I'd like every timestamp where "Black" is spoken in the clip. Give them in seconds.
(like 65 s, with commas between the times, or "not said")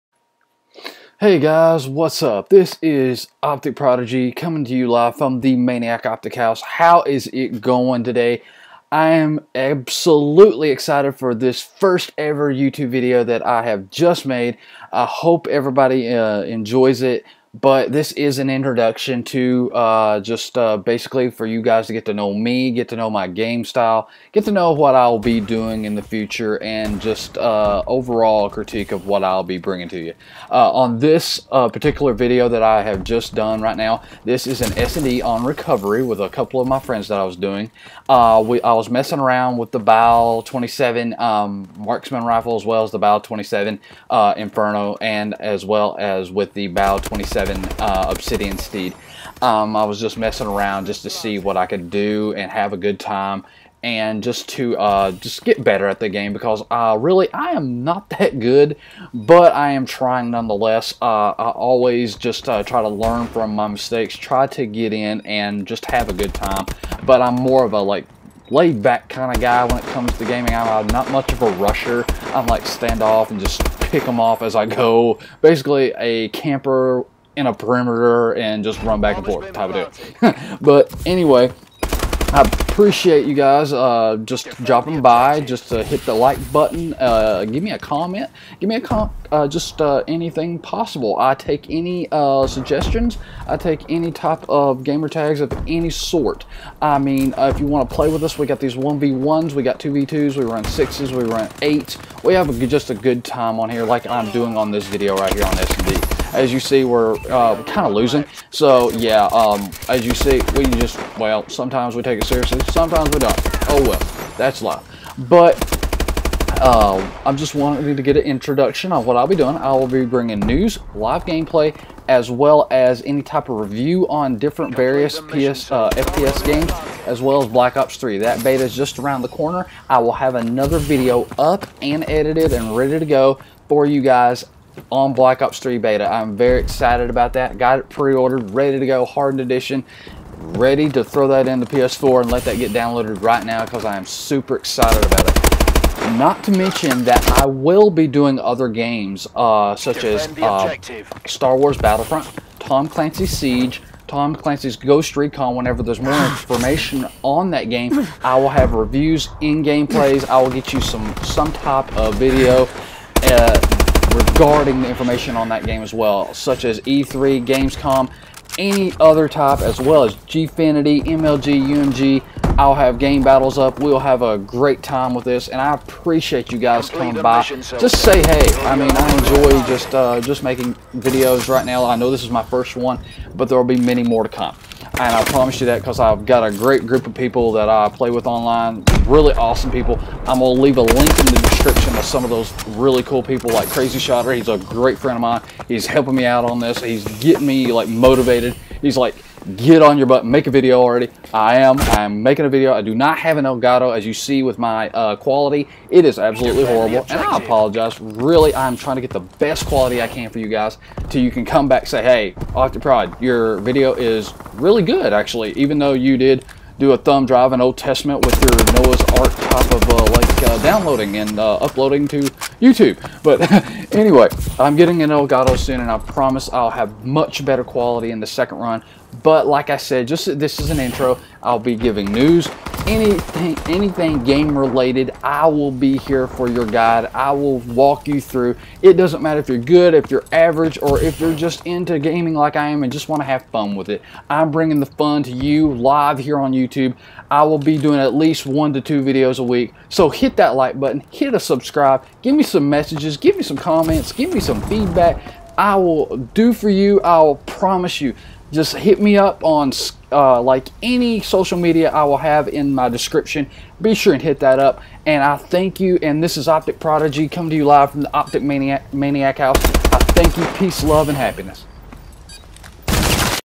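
127 s, 135 s.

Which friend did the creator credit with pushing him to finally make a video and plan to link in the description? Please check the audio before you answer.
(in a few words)
Crazyshotter.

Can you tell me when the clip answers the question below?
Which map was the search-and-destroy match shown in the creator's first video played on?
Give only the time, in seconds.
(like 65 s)
35 s.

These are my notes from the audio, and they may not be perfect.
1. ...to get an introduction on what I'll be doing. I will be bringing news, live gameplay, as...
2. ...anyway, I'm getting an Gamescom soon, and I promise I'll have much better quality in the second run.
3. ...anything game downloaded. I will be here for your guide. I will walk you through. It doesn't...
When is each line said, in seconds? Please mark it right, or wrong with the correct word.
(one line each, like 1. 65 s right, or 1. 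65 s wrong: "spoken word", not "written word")
1. 117 s right
2. 223 s wrong: "Elgato", not "Gamescom"
3. 233 s wrong: "related", not "downloaded".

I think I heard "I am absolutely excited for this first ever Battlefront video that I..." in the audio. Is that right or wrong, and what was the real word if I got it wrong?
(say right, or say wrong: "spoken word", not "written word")
wrong: "YouTube", not "Battlefront".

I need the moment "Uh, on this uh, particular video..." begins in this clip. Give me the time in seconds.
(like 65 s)
30 s.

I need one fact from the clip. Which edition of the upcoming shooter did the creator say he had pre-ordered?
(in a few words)
Hardened edition.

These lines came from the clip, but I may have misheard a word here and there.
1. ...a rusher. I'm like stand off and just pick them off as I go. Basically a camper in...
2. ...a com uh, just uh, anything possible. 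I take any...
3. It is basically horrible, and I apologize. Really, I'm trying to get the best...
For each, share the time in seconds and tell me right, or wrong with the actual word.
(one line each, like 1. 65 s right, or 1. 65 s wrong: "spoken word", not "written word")
1. 71 s right
2. 88 s right
3. 205 s wrong: "absolutely", not "basically".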